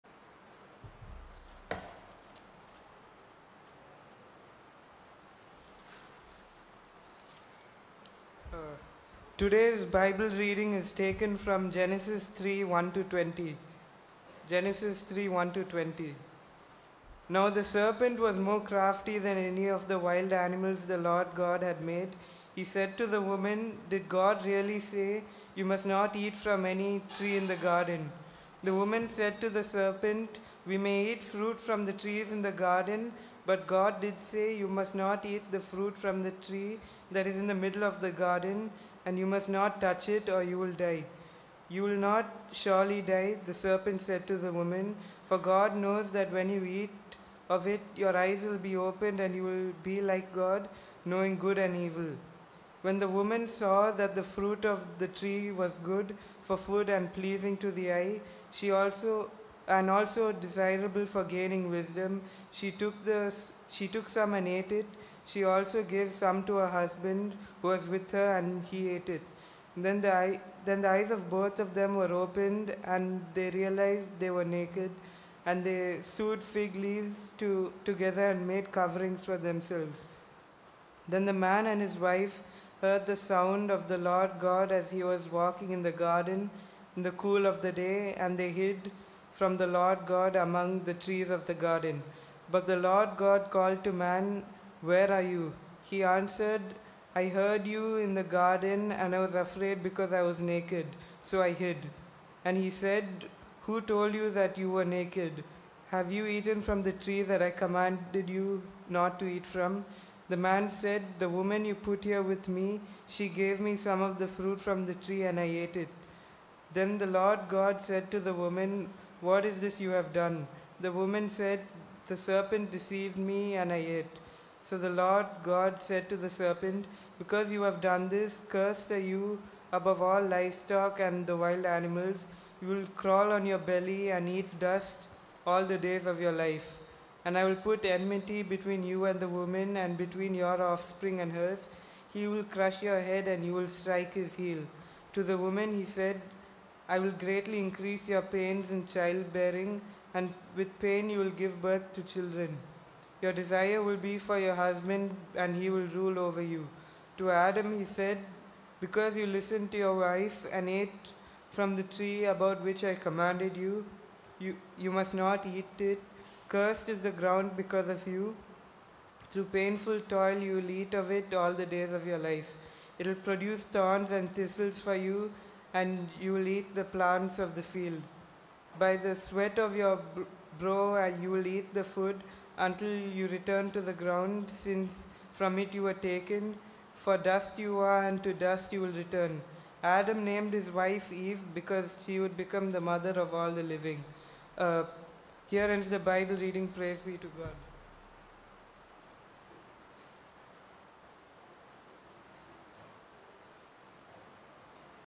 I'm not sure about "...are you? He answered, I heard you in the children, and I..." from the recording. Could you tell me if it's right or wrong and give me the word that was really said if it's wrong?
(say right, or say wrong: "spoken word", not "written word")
wrong: "garden", not "children".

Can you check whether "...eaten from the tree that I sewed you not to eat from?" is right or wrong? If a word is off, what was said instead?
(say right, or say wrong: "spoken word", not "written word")
wrong: "commanded", not "sewed".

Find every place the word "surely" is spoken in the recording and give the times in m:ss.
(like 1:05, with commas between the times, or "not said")
0:42.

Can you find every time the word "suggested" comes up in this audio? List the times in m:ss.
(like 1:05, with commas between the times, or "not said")
not said.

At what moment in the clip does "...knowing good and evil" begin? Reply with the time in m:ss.
0:51.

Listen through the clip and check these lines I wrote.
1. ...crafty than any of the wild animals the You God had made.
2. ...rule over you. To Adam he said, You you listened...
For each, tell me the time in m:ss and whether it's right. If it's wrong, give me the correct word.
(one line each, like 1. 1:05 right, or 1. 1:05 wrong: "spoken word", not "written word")
1. 0:18 wrong: "Lord", not "You"
2. 2:35 wrong: "Because", not "You".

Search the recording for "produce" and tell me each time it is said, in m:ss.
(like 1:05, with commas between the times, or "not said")
2:53.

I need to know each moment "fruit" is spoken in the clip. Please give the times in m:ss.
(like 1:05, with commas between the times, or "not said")
0:31, 0:35, 0:54, 1:54.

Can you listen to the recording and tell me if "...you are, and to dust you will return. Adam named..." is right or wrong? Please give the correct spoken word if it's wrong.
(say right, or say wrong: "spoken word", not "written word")
right.